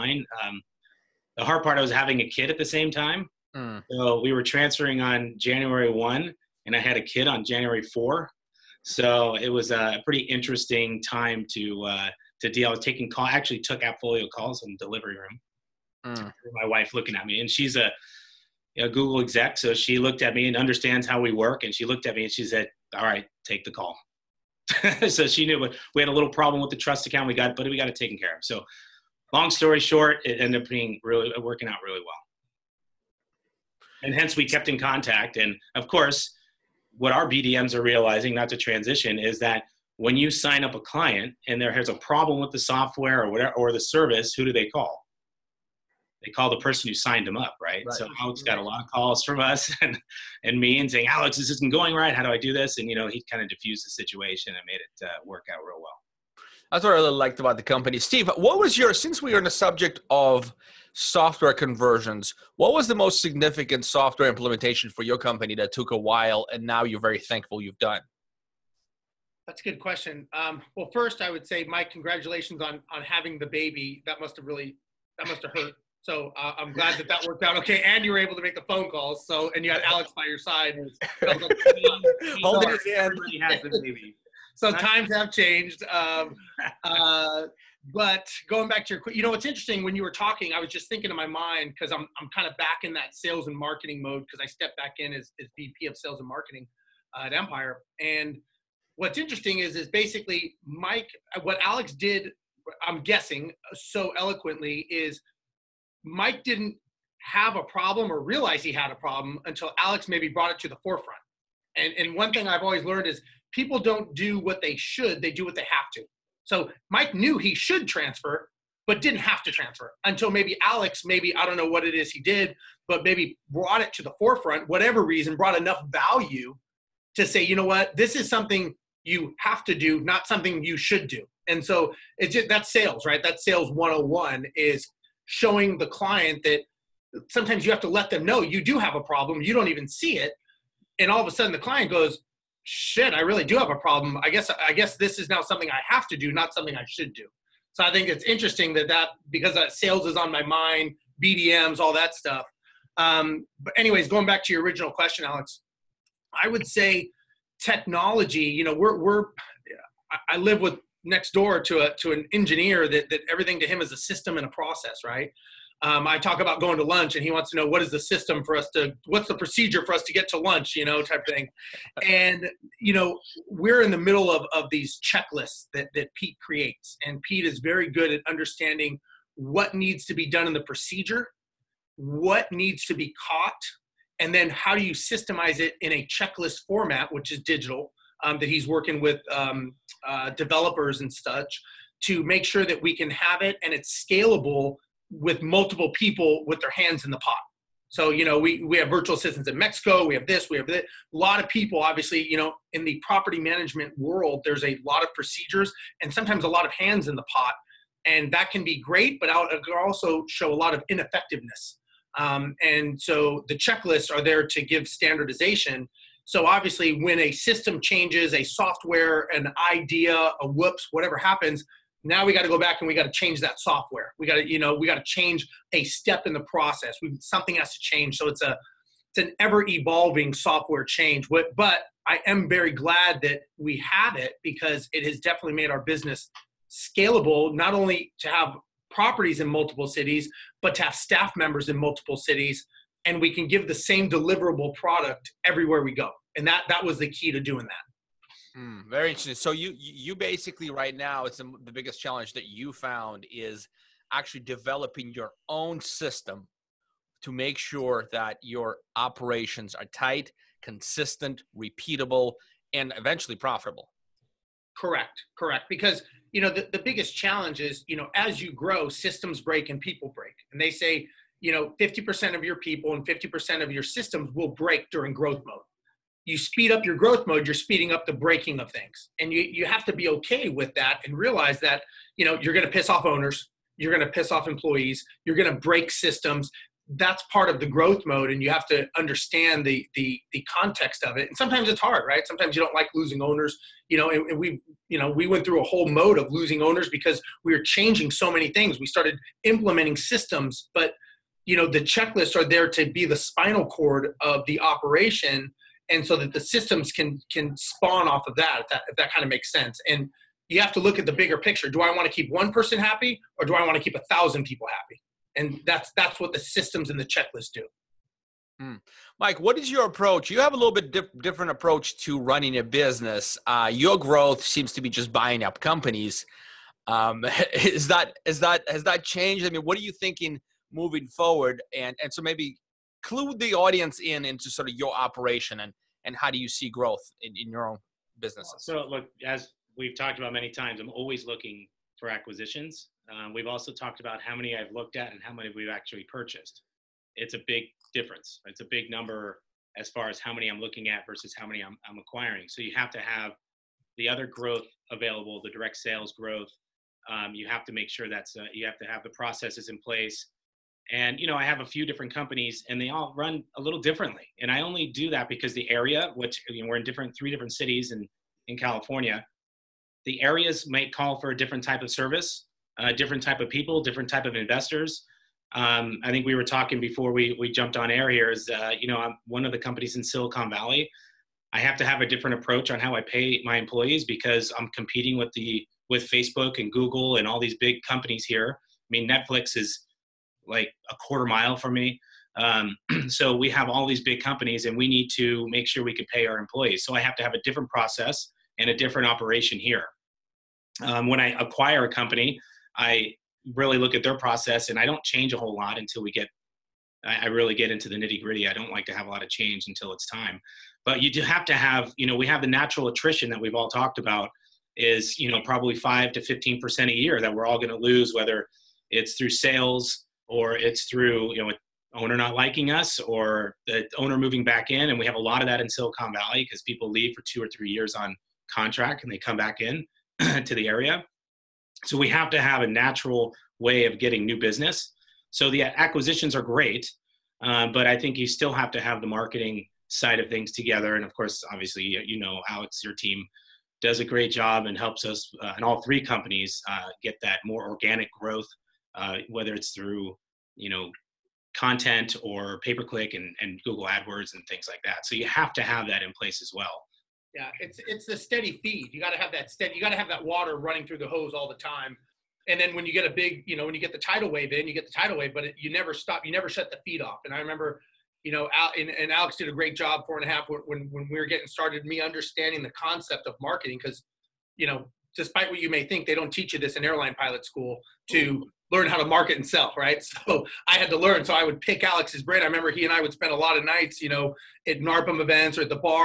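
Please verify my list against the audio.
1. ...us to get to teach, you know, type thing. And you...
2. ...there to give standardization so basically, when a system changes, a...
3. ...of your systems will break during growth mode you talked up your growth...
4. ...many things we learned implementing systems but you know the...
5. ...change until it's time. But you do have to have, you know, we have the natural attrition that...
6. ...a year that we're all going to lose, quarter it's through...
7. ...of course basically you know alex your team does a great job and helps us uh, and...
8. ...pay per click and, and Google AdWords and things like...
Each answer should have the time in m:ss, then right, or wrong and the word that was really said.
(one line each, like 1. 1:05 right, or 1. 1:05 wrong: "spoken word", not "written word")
1. 2:49 wrong: "lunch", not "teach"
2. 3:34 wrong: "obviously", not "basically"
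3. 4:33 wrong: "speed", not "talked"
4. 4:58 wrong: "started", not "learned"
5. 6:49 right
6. 6:56 wrong: "whether", not "quarter"
7. 7:21 wrong: "obviously", not "basically"
8. 7:32 right.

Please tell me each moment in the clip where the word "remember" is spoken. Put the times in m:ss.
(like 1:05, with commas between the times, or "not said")
7:47, 8:02.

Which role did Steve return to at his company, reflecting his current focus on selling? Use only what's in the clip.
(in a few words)
VP of sales and marketing.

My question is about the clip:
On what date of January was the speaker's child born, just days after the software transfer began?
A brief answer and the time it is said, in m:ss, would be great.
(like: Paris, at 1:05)
January 4, at 0:07.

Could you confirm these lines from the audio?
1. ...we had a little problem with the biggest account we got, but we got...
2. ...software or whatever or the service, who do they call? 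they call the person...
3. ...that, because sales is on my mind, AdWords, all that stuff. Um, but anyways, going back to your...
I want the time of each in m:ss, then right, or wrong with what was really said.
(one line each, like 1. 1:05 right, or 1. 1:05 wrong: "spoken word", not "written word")
1. 0:25 wrong: "trust", not "biggest"
2. 0:42 right
3. 2:28 wrong: "BDMs", not "AdWords".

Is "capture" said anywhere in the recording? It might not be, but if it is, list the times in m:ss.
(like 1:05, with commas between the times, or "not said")
not said.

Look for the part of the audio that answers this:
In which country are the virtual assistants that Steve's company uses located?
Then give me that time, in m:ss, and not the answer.
3:19.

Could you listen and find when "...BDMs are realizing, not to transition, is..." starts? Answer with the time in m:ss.
0:37.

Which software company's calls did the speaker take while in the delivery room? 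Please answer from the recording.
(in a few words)
Appfolio.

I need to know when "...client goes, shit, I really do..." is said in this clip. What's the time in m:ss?
2:21.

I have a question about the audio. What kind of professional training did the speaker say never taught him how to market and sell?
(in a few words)
Airline pilot school.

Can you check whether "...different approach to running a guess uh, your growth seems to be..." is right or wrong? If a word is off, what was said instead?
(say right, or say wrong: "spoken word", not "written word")
wrong: "business", not "guess".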